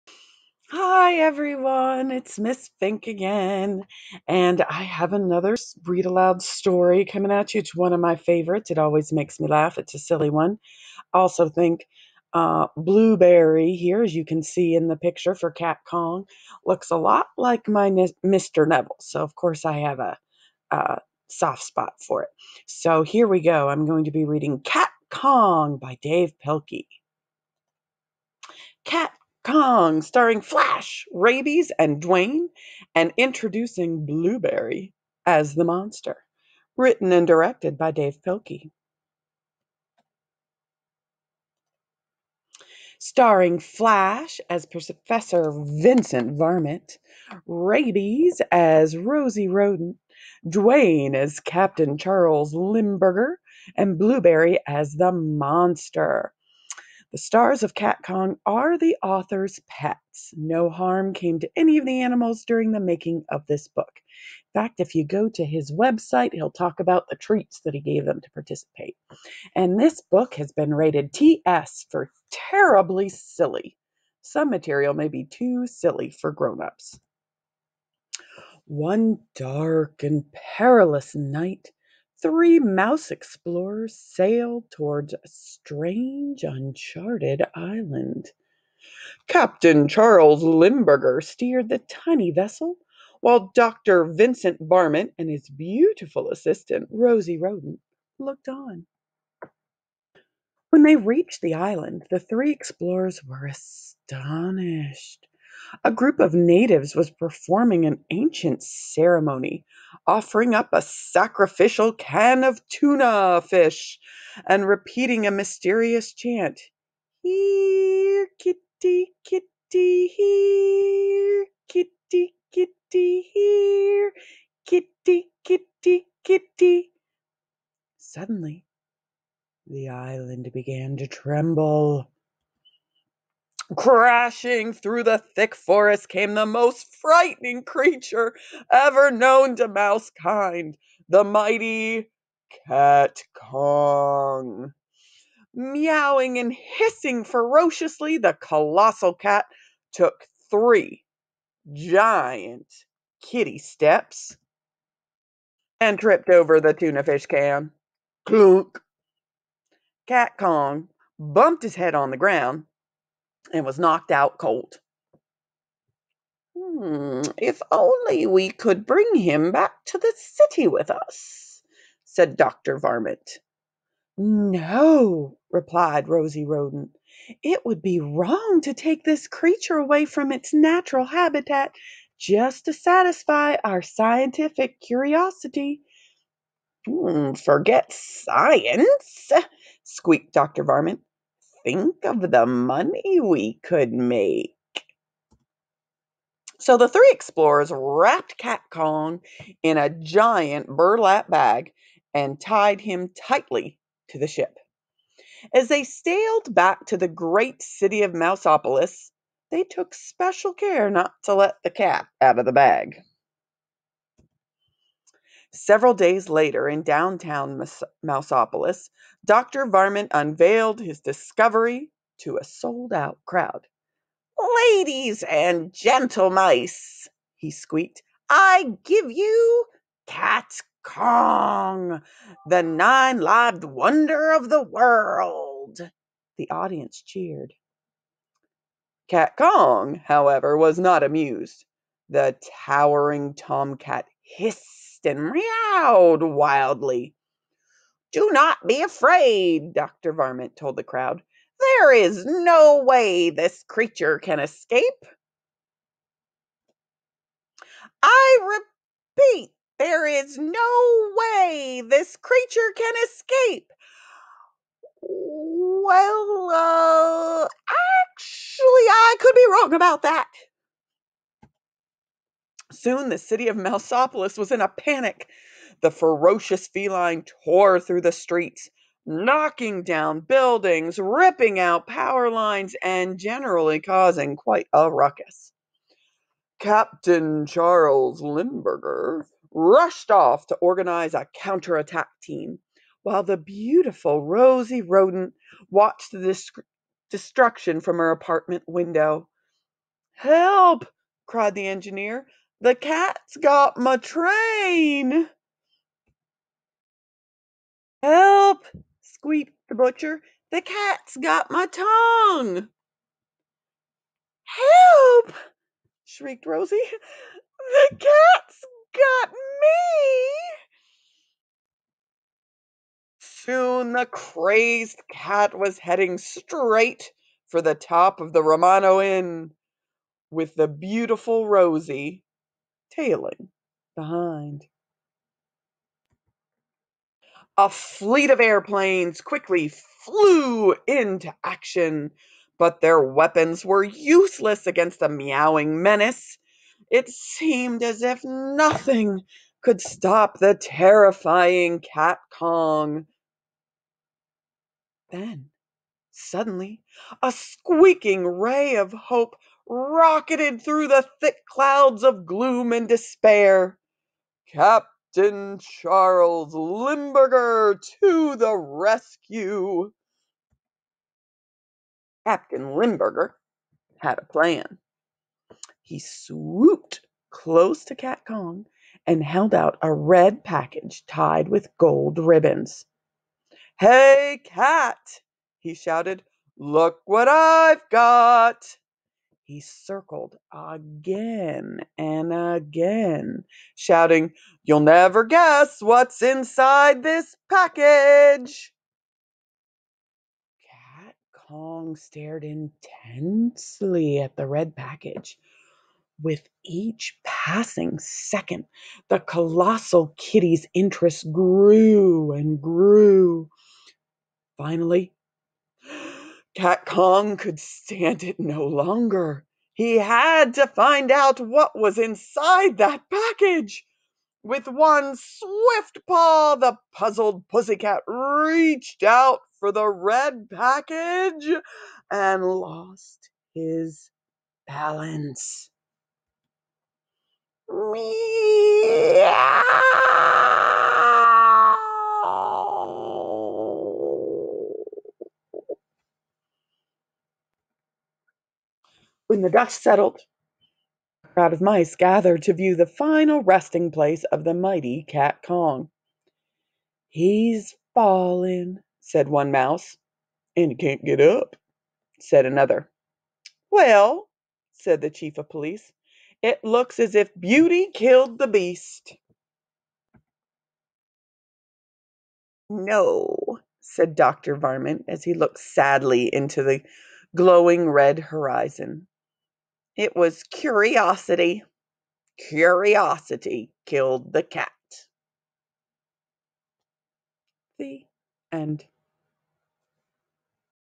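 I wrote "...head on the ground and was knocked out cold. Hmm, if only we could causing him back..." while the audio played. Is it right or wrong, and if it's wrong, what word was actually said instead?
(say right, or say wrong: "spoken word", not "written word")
wrong: "bring", not "causing".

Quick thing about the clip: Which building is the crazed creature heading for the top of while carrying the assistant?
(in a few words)
Romano Inn.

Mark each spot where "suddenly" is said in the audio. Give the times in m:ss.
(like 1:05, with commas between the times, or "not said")
2:07, 5:56.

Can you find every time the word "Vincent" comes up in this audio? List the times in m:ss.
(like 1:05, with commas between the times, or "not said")
0:45, 1:34.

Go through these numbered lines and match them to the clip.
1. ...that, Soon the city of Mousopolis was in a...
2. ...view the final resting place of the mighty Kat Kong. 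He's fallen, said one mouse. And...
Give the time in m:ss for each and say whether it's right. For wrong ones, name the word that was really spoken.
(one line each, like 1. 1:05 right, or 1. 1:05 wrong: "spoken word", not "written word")
1. 4:30 right
2. 7:32 right.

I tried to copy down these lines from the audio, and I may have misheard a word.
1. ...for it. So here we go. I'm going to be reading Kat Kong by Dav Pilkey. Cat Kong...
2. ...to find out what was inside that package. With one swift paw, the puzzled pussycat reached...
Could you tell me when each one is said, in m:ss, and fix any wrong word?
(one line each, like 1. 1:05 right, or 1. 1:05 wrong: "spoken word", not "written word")
1. 0:22 right
2. 7:00 right.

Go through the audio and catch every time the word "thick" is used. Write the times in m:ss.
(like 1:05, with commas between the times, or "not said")
2:15, 6:01.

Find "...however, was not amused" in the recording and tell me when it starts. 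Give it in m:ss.
3:59.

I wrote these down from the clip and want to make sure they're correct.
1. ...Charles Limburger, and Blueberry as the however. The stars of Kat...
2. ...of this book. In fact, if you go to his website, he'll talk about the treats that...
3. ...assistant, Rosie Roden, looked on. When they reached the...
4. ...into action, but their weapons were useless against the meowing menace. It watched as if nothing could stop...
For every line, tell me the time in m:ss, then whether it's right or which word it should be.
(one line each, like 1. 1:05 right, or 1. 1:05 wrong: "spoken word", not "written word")
1. 0:51 wrong: "monster", not "however"
2. 1:03 right
3. 1:36 right
4. 5:40 wrong: "seemed", not "watched".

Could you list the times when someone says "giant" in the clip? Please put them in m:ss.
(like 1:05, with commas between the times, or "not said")
2:31, 3:19.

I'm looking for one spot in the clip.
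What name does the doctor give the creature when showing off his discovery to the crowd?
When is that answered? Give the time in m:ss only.
3:52.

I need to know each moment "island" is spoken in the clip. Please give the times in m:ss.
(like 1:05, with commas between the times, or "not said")
1:27, 1:41, 2:09.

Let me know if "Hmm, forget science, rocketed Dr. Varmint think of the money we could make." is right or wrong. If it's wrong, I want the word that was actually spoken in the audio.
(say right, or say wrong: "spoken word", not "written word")
wrong: "squeaked", not "rocketed".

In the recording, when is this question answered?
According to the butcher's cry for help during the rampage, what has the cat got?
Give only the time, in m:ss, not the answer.
5:11.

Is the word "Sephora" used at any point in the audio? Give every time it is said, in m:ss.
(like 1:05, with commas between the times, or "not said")
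not said.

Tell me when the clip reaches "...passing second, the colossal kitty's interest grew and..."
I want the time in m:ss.
6:47.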